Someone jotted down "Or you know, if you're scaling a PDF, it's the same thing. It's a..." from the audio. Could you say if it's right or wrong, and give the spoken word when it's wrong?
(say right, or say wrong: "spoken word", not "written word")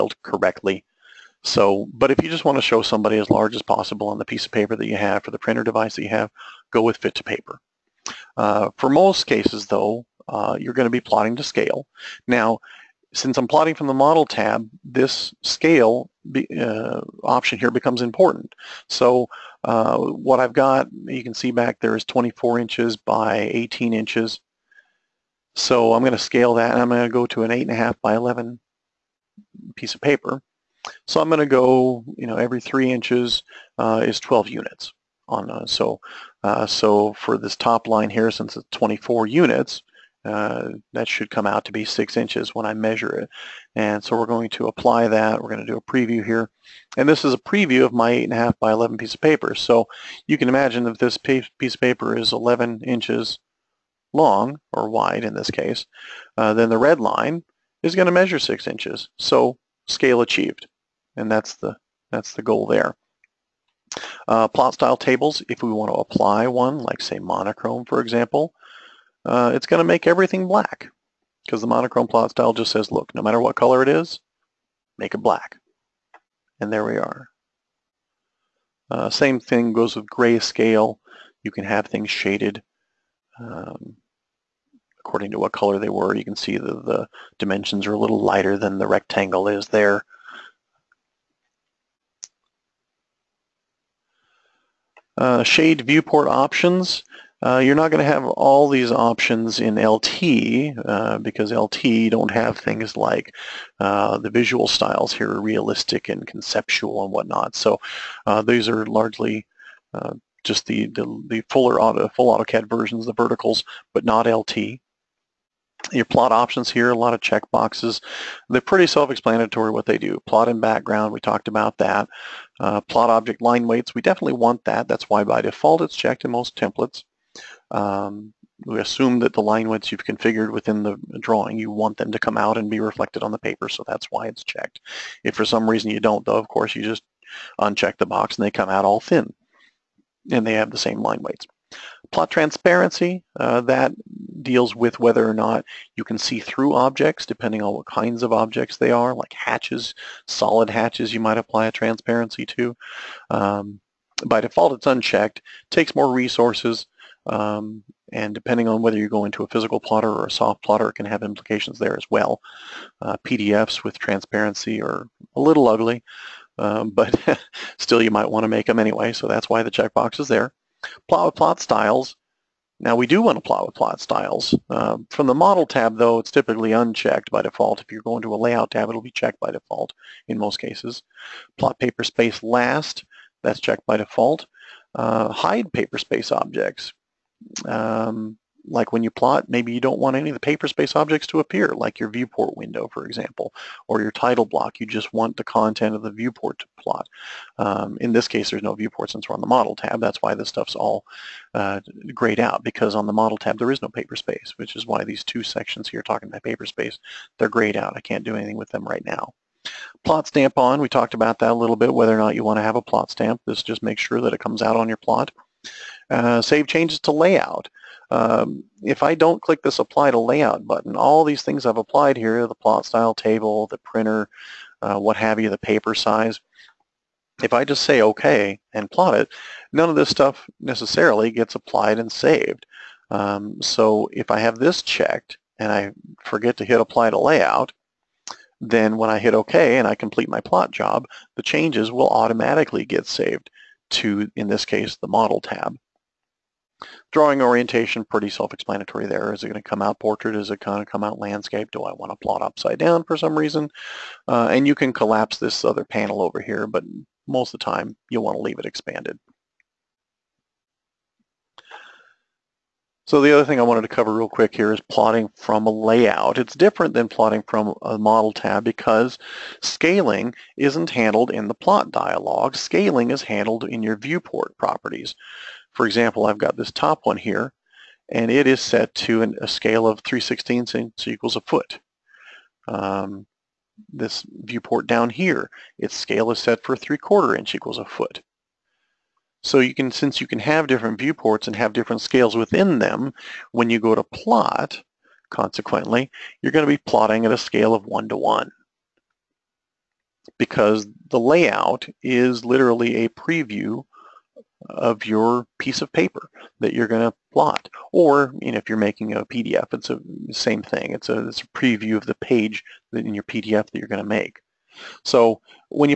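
wrong: "making", not "scaling".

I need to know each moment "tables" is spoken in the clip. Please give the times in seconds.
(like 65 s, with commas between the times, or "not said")
64 s, 223 s.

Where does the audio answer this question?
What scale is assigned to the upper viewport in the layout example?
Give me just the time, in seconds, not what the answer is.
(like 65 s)
280 s.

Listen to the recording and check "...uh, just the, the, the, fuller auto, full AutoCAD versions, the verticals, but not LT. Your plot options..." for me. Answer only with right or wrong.
right.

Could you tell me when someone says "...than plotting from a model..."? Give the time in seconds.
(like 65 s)
266 s.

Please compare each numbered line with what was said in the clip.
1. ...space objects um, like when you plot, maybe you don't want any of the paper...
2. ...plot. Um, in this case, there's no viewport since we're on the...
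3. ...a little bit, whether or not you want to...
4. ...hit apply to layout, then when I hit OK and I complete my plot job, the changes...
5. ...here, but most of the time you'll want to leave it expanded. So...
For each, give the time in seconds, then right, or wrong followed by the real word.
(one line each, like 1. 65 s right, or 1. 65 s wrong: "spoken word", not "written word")
1. 185 s right
2. 196 s right
3. 211 s right
4. 236 s right
5. 256 s right.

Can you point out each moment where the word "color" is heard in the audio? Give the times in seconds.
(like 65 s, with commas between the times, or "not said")
73 s, 85 s.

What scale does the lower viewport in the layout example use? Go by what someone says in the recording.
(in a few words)
3/4 inch equals a foot.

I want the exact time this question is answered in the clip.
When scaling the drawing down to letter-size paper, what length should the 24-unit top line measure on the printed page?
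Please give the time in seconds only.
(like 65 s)
41 s.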